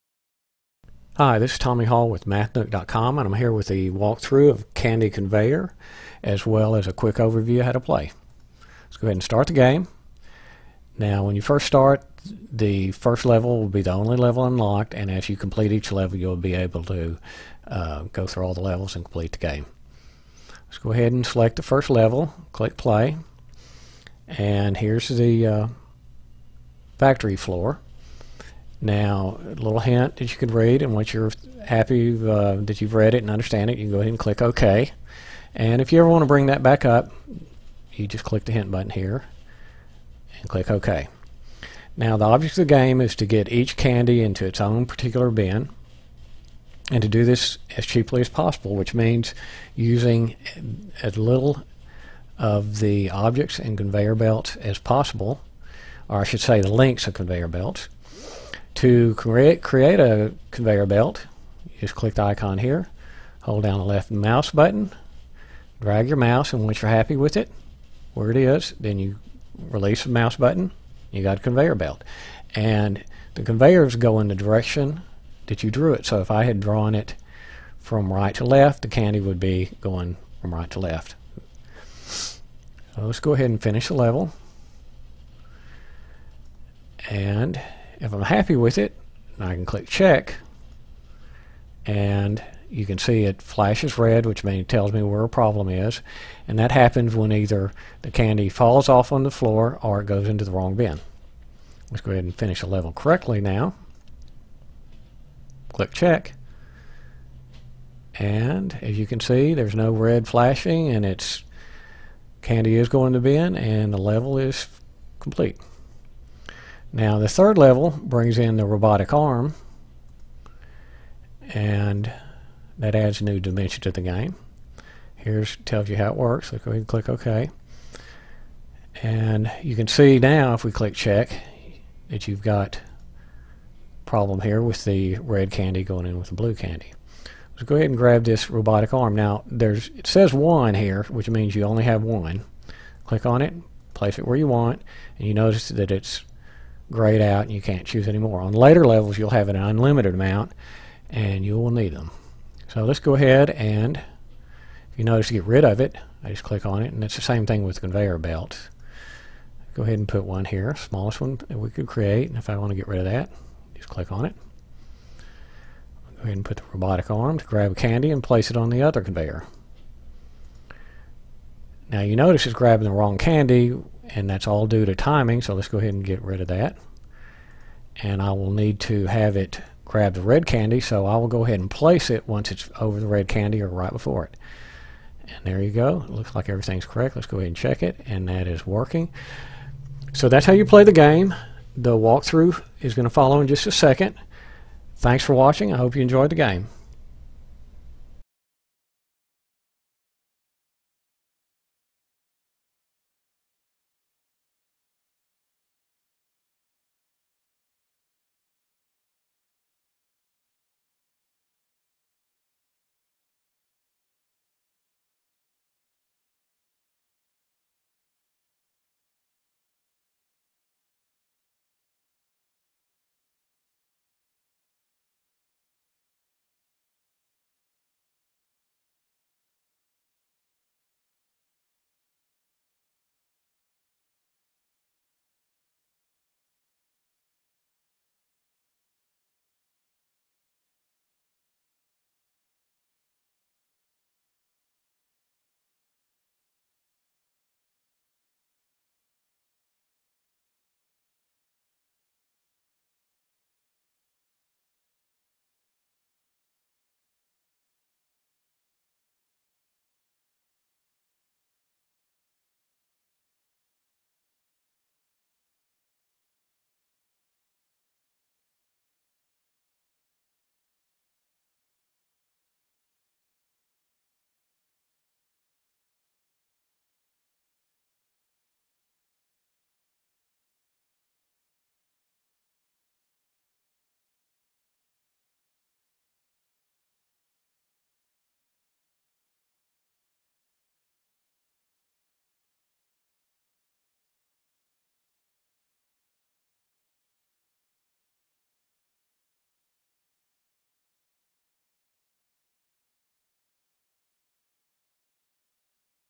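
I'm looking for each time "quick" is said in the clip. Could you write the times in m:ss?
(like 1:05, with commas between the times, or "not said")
0:06.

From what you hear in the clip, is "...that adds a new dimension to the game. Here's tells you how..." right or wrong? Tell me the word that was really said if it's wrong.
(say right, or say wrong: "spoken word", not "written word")
right.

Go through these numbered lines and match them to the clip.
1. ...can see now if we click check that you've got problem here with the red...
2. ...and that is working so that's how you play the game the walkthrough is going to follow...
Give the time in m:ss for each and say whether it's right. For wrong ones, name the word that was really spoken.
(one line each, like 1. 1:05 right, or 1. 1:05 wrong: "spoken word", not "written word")
1. 2:09 right
2. 3:08 right.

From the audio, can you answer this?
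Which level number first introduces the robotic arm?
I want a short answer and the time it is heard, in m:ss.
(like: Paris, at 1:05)
3, at 1:57.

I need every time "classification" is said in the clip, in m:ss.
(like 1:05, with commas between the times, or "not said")
not said.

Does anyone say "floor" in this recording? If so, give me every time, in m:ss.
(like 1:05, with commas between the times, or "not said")
0:27, 1:39.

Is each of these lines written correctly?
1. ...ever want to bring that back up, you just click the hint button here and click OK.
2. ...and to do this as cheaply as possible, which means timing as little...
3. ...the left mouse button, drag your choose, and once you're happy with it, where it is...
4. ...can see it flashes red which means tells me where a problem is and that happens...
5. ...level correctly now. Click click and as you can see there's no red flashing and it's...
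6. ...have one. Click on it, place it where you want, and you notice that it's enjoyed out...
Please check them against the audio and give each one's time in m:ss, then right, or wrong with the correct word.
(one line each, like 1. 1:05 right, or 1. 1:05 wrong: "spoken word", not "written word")
1. 0:35 right
2. 0:46 wrong: "using", not "timing"
3. 1:03 wrong: "mouse", not "choose"
4. 1:32 right
5. 1:42 wrong: "check", not "click"
6. 2:21 wrong: "grayed", not "enjoyed".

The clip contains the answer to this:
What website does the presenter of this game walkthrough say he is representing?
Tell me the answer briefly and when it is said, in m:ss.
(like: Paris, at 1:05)
MathNook.com, at 0:02.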